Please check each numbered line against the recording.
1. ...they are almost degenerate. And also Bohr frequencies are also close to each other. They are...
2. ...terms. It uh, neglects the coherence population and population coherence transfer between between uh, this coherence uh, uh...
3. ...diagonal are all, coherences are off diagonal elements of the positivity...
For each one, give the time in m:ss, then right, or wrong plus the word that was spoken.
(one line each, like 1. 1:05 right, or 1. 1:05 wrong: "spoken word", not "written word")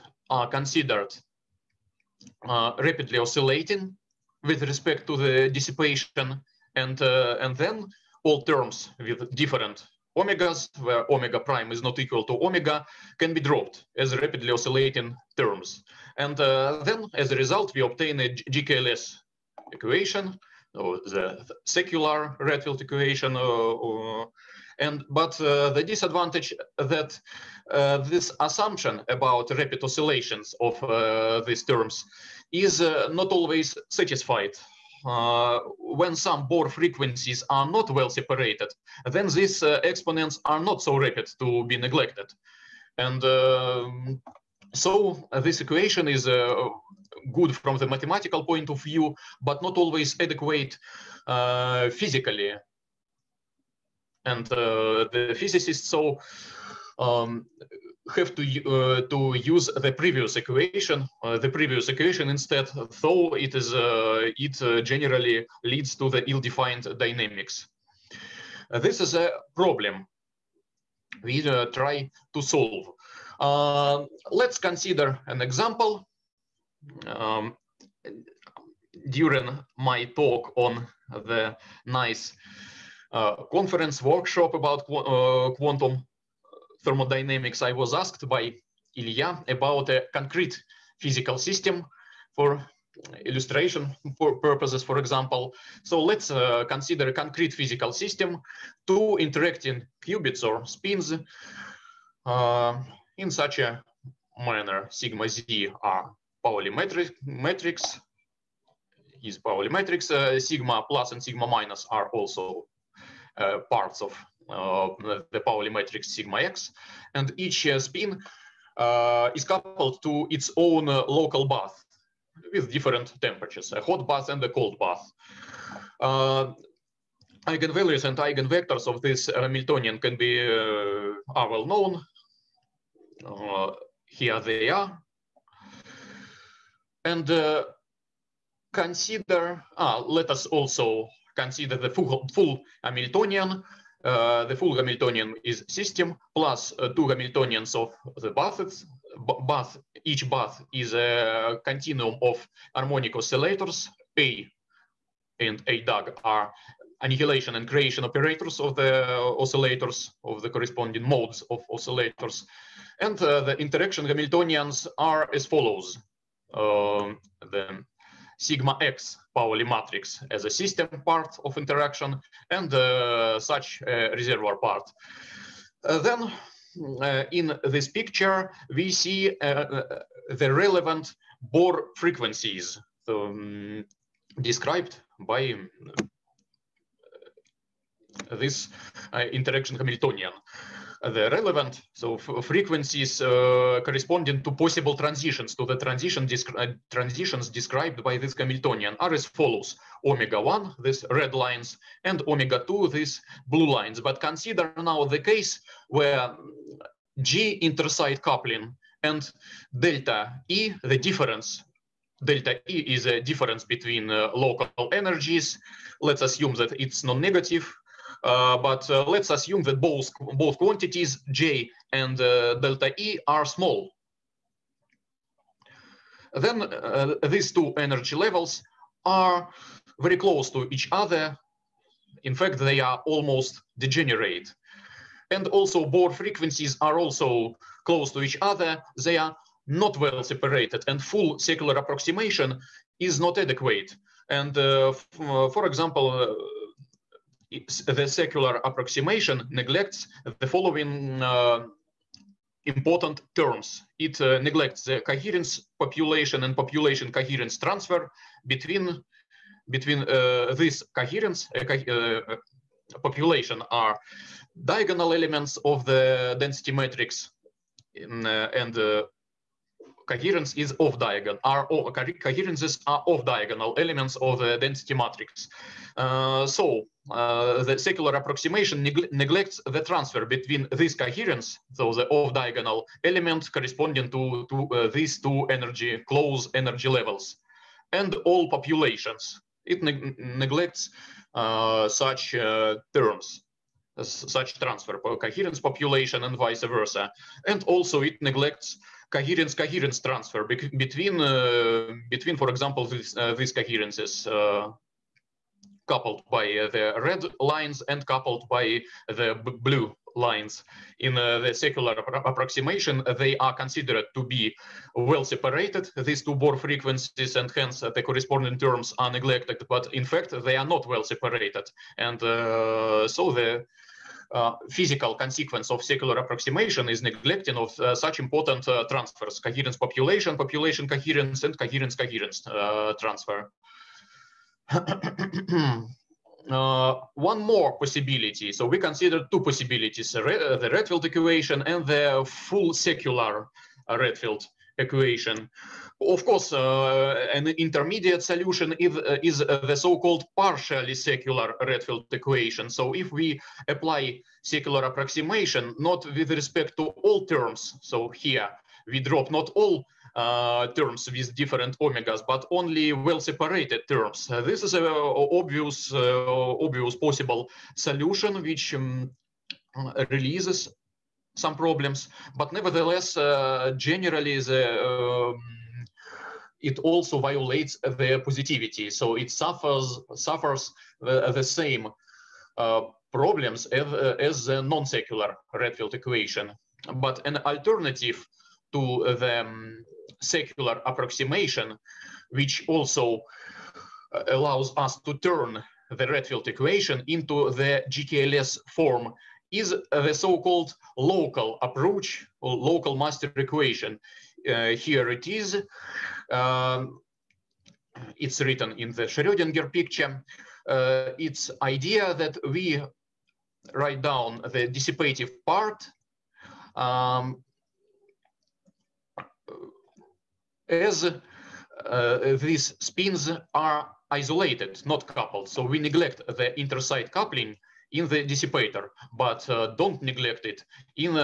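1. 3:52 right
2. 4:13 right
3. 4:30 wrong: "density", not "positivity".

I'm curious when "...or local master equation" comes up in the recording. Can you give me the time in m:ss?
6:42.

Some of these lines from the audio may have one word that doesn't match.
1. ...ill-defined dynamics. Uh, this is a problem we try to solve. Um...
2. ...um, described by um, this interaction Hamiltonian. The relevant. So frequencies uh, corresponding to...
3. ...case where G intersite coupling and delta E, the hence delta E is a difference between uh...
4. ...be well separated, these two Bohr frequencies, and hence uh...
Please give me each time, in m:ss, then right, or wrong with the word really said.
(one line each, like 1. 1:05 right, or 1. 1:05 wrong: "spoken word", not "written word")
1. 1:06 right
2. 3:03 right
3. 3:25 wrong: "difference", not "hence"
4. 5:14 right.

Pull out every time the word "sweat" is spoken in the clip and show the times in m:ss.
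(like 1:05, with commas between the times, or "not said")
not said.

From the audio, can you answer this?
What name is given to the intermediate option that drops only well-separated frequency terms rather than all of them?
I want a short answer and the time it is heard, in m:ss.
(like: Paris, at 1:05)
Partially secular Redfield equation, at 5:50.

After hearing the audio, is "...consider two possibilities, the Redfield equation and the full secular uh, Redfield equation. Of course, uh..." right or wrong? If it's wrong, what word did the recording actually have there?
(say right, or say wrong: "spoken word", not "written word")
right.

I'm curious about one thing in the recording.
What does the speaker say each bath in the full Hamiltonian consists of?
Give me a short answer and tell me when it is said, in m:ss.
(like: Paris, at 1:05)
A continuum of harmonic oscillators, at 2:31.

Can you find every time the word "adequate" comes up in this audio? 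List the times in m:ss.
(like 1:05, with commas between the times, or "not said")
0:50, 4:03.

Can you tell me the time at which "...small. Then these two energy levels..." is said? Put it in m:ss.
3:43.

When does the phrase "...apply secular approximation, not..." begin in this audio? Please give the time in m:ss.
5:53.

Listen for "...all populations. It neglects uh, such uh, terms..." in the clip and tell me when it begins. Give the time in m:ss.
4:48.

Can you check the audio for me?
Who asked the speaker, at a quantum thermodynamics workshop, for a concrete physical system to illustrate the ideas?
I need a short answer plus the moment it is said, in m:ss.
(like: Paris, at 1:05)
Ilya, at 1:28.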